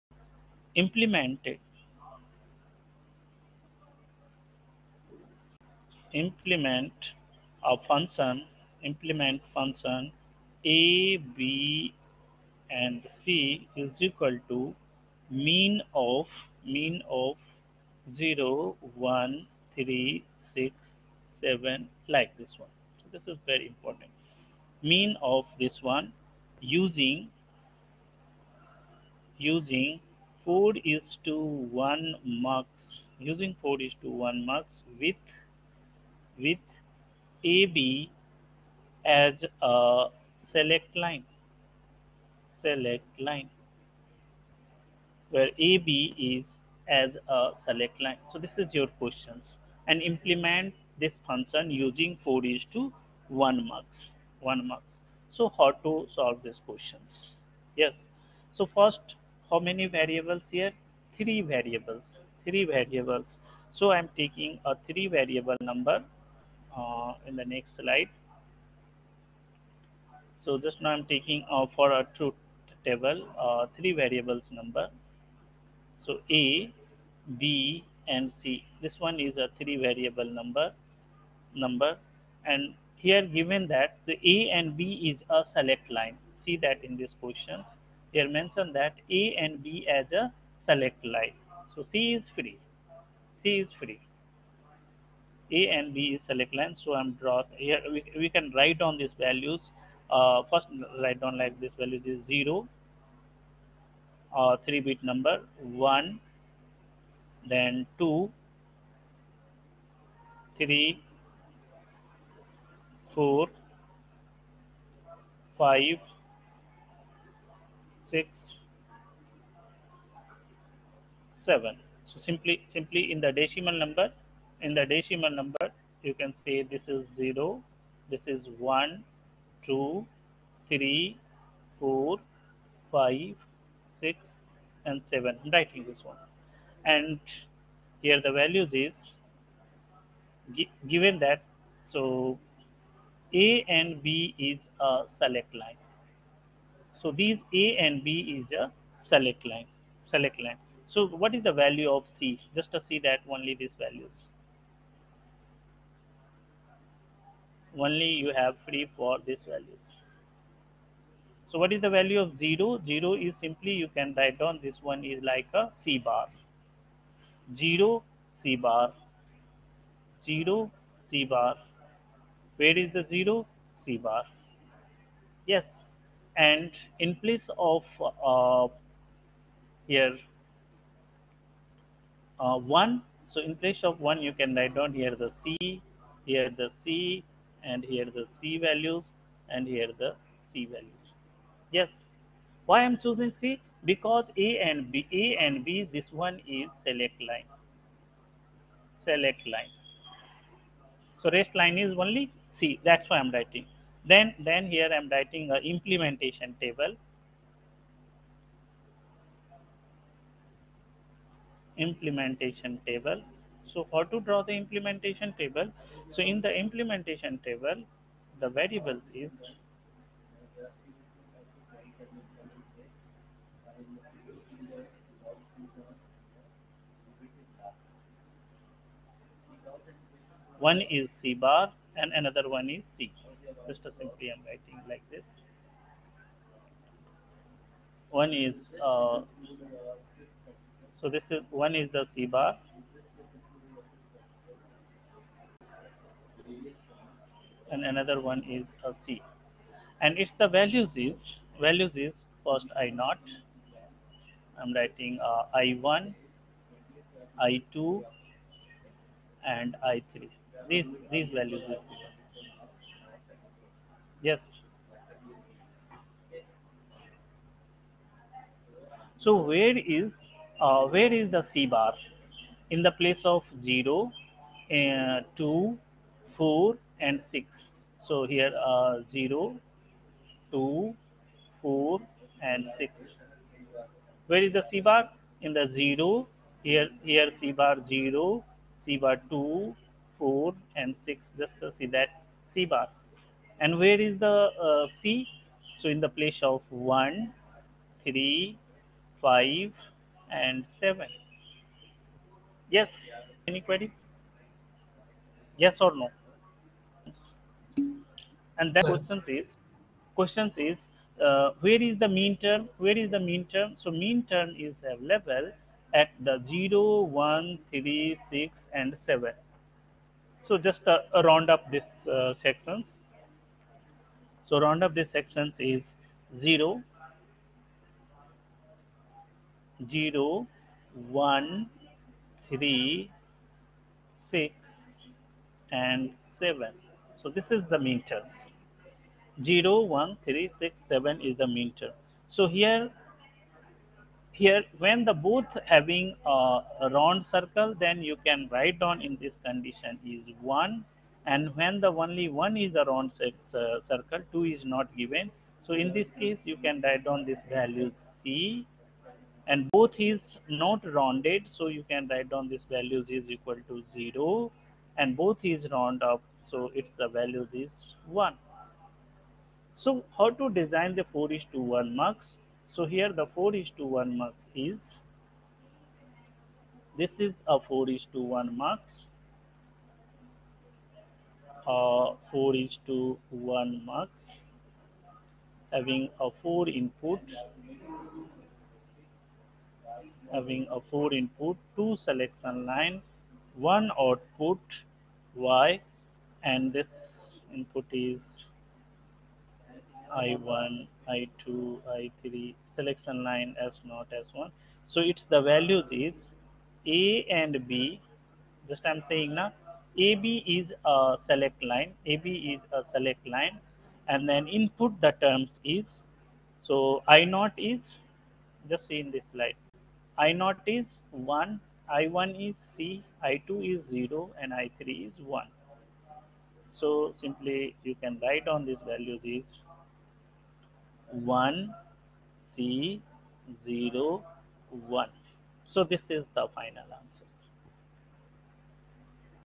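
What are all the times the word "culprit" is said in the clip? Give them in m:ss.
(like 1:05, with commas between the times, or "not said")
not said.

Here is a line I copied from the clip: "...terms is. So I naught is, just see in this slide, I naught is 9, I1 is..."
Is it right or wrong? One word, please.
wrong.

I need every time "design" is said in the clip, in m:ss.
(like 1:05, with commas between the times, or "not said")
6:10.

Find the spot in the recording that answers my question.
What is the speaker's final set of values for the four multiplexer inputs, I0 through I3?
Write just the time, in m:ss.
7:11.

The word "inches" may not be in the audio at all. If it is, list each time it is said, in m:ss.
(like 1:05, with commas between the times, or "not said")
not said.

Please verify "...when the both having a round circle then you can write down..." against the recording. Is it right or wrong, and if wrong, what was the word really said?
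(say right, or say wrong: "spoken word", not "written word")
right.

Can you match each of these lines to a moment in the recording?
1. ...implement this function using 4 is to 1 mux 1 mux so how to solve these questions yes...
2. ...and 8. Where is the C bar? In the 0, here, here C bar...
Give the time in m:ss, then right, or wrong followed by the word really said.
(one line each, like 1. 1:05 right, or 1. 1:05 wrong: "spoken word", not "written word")
1. 0:50 right
2. 4:42 wrong: "6", not "8".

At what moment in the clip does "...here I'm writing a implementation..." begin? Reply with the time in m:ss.
3:24.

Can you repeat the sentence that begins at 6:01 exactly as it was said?
So you can write down this value is equal to zero and both is round up.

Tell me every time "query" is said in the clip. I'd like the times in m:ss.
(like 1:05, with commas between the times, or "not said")
5:03.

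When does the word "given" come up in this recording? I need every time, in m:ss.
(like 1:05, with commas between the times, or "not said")
1:23, 2:20, 5:54.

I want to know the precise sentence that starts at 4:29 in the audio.
So where is uh, where is the C bar?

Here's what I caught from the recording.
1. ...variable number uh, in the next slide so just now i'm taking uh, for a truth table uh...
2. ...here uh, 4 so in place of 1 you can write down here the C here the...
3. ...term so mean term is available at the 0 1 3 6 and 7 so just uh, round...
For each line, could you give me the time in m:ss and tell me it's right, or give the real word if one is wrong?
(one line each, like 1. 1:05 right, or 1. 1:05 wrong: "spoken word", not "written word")
1. 1:05 right
2. 2:59 wrong: "1", not "4"
3. 5:13 right.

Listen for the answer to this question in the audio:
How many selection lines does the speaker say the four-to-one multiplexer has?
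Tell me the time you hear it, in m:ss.
6:31.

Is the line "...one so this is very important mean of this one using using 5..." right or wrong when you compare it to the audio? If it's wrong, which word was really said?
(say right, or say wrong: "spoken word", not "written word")
wrong: "4", not "5".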